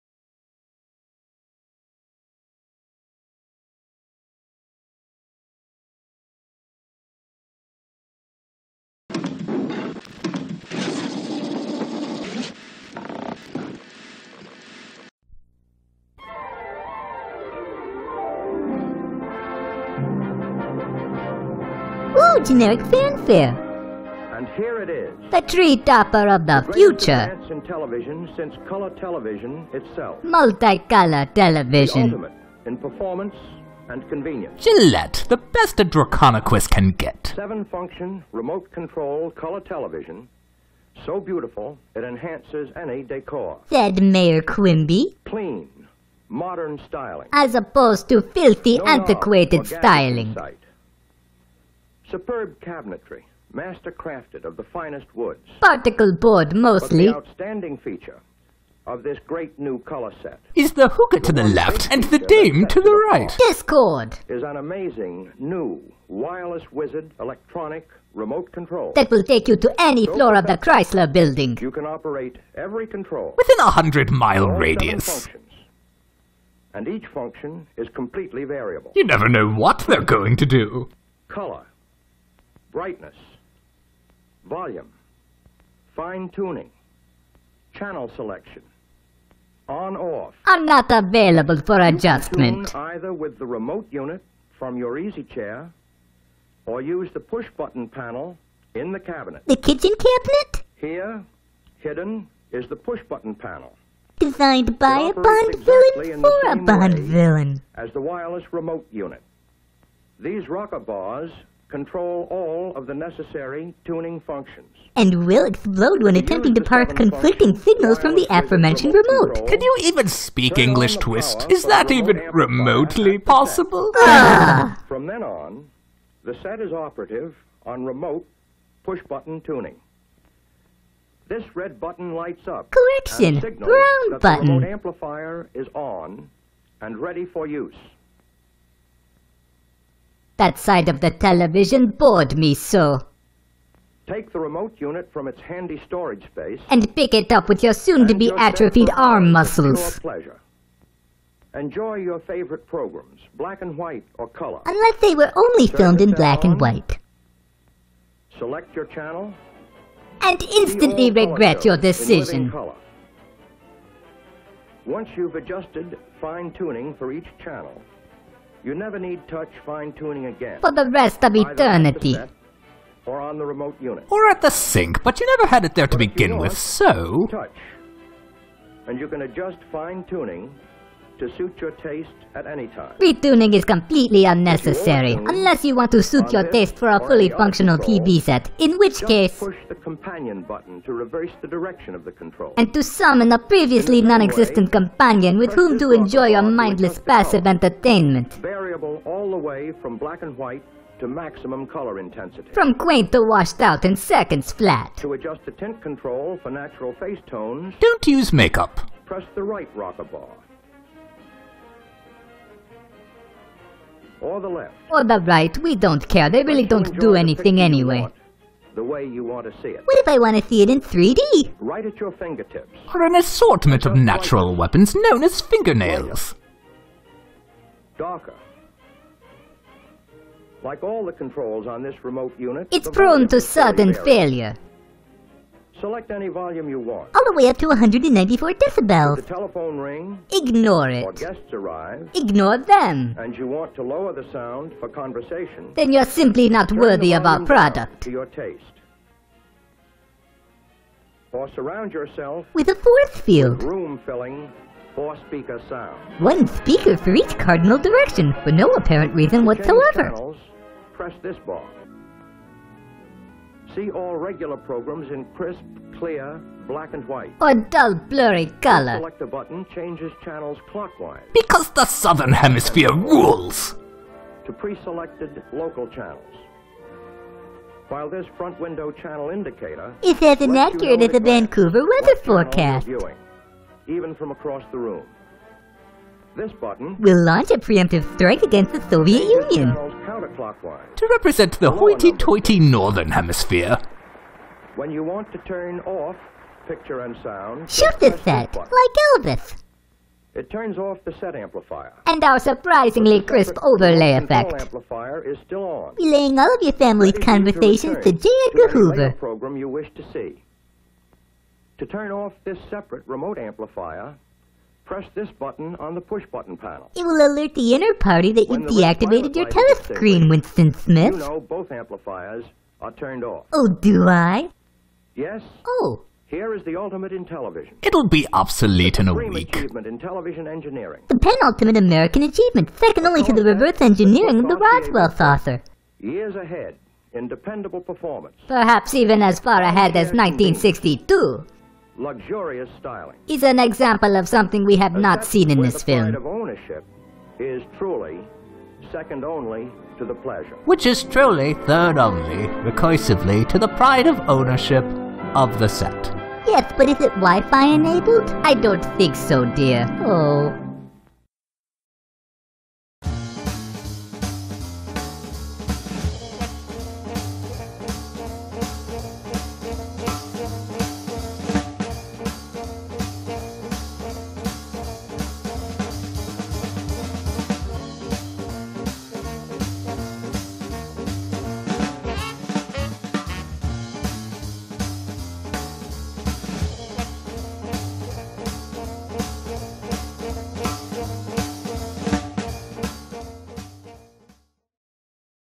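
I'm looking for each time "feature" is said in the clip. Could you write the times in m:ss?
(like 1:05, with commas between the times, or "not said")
0:57.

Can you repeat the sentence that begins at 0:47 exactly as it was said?
As opposed to filthy, no antiquated styling.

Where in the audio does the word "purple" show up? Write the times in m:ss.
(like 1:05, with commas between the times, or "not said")
not said.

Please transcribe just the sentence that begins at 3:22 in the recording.
From quaint to washed out in seconds flat.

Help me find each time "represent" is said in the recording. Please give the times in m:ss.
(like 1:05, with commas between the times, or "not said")
4:51.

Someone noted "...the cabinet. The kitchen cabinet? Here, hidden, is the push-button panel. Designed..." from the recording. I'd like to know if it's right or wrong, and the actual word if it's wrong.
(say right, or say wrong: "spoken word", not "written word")
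right.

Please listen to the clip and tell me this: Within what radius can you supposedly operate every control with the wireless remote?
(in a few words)
100 miles.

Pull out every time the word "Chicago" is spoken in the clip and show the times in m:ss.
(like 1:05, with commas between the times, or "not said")
not said.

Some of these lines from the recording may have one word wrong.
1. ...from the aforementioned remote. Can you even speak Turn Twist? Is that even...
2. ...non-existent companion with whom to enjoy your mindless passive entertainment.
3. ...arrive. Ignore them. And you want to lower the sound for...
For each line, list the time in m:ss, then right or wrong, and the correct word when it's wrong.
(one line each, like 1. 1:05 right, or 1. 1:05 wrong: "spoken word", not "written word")
1. 1:57 wrong: "English", not "Turn"
2. 3:14 right
3. 4:01 right.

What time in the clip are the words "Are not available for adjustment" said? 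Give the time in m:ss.
1:30.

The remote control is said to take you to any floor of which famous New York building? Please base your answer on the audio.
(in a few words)
Chrysler building.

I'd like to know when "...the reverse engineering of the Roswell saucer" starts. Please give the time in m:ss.
5:33.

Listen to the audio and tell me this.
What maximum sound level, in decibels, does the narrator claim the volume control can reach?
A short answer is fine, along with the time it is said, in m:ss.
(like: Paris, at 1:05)
194, at 3:57.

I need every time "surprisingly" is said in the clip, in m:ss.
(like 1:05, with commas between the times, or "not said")
5:02.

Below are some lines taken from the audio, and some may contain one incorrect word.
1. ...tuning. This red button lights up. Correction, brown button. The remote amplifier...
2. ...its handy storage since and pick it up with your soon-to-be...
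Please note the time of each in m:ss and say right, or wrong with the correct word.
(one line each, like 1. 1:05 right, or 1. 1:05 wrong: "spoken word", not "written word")
1. 2:09 right
2. 2:25 wrong: "space", not "since".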